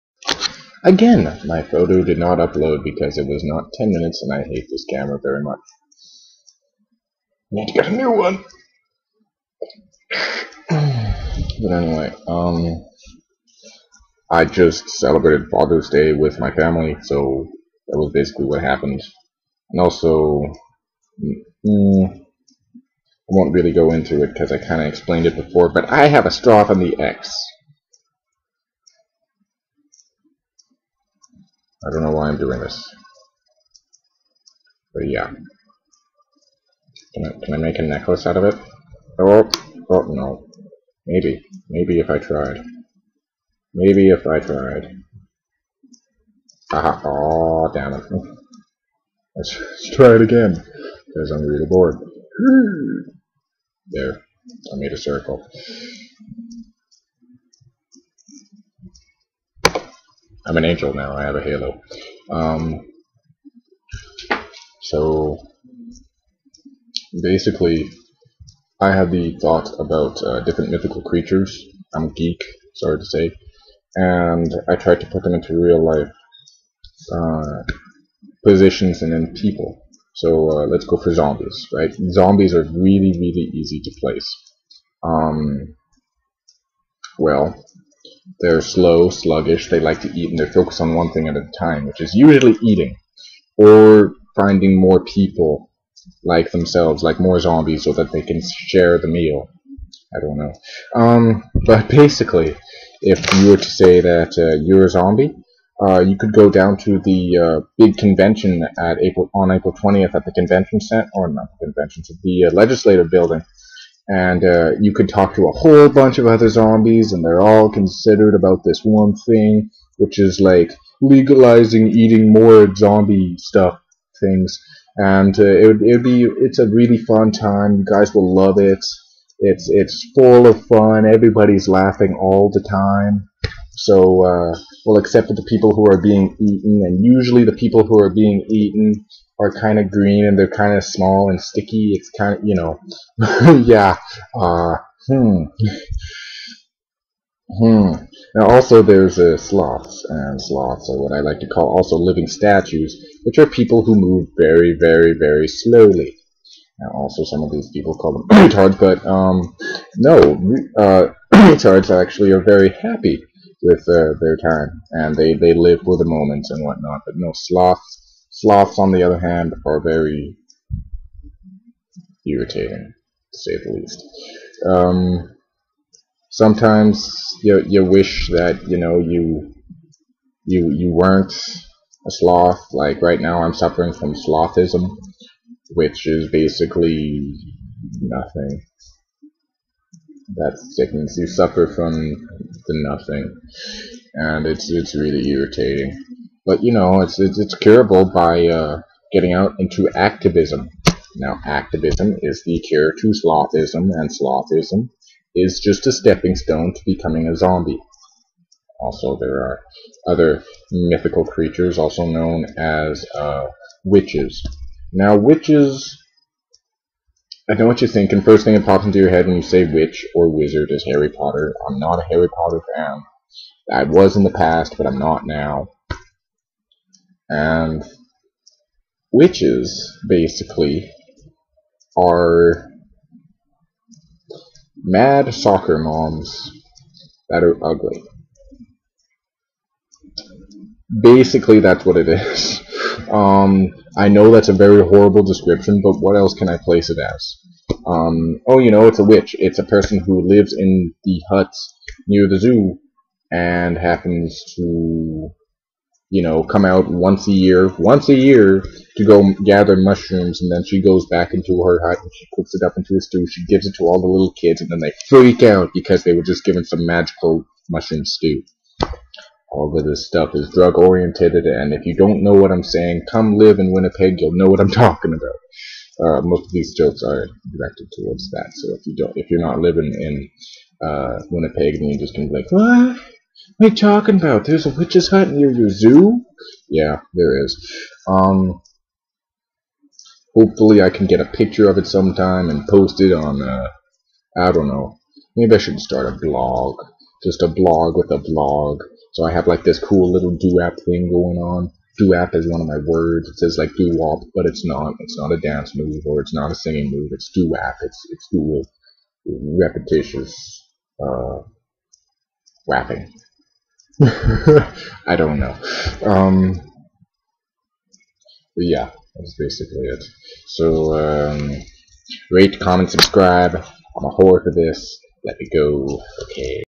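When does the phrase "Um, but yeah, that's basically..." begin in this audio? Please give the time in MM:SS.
05:16.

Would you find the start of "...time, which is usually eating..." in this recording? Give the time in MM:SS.
01:31.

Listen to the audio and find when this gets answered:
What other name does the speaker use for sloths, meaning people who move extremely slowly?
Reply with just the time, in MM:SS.
02:31.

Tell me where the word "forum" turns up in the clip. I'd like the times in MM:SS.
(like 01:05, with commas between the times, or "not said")
not said.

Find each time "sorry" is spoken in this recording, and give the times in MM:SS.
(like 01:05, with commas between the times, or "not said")
01:12.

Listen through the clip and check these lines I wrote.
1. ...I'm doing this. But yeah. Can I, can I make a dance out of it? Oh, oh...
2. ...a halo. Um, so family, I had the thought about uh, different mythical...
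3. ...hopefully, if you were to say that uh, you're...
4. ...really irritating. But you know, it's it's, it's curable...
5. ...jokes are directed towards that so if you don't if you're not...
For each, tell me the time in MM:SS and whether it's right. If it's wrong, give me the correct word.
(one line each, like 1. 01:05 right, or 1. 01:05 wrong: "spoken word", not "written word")
1. 00:32 wrong: "necklace", not "dance"
2. 01:01 wrong: "basically", not "family"
3. 01:41 wrong: "basically", not "hopefully"
4. 03:14 right
5. 04:36 right.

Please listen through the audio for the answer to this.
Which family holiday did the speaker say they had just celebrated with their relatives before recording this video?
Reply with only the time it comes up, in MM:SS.
00:15.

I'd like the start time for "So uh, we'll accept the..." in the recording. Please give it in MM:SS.
02:13.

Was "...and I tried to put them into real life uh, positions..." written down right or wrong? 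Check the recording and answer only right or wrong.
right.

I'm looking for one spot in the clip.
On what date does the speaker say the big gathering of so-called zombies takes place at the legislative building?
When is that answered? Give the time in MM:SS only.
01:49.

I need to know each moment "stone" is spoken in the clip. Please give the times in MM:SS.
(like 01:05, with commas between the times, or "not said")
03:26.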